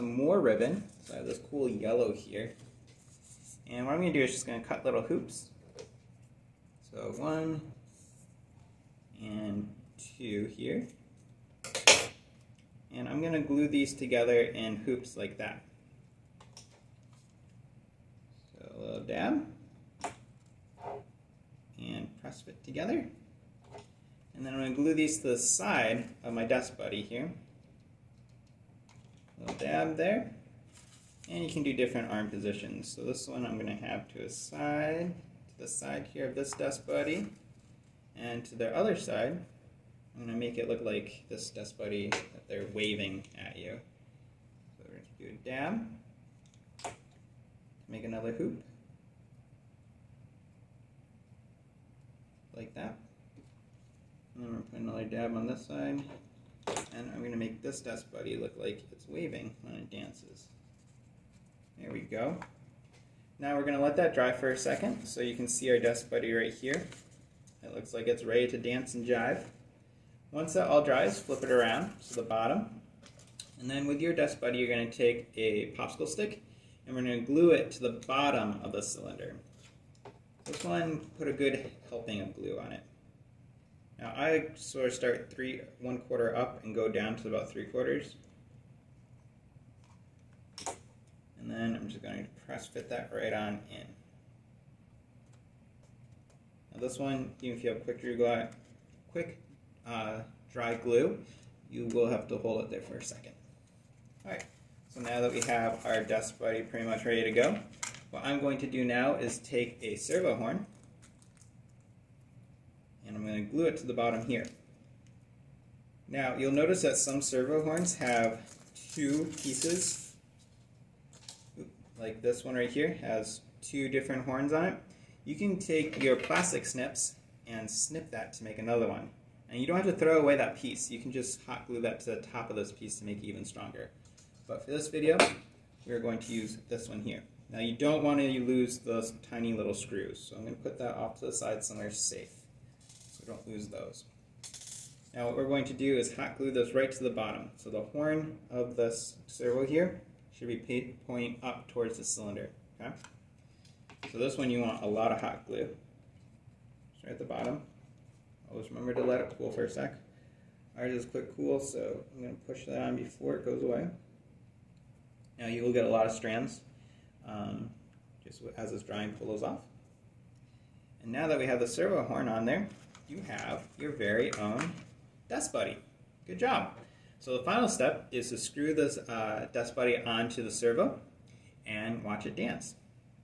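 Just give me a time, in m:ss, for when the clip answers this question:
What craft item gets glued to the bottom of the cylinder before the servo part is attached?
1:15.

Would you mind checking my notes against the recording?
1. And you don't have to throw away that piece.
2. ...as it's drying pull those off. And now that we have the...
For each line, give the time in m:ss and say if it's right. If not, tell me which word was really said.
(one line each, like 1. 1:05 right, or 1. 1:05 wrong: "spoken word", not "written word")
1. 2:09 right
2. 2:48 right.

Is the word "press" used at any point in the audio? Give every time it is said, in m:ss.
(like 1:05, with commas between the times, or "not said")
0:22, 1:32.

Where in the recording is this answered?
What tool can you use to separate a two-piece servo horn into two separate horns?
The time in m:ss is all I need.
2:06.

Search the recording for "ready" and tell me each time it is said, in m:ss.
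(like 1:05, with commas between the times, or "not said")
1:08, 1:47.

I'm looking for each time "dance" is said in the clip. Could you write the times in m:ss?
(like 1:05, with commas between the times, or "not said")
0:59, 1:08, 3:02.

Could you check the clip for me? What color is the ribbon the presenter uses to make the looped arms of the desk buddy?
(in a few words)
Yellow.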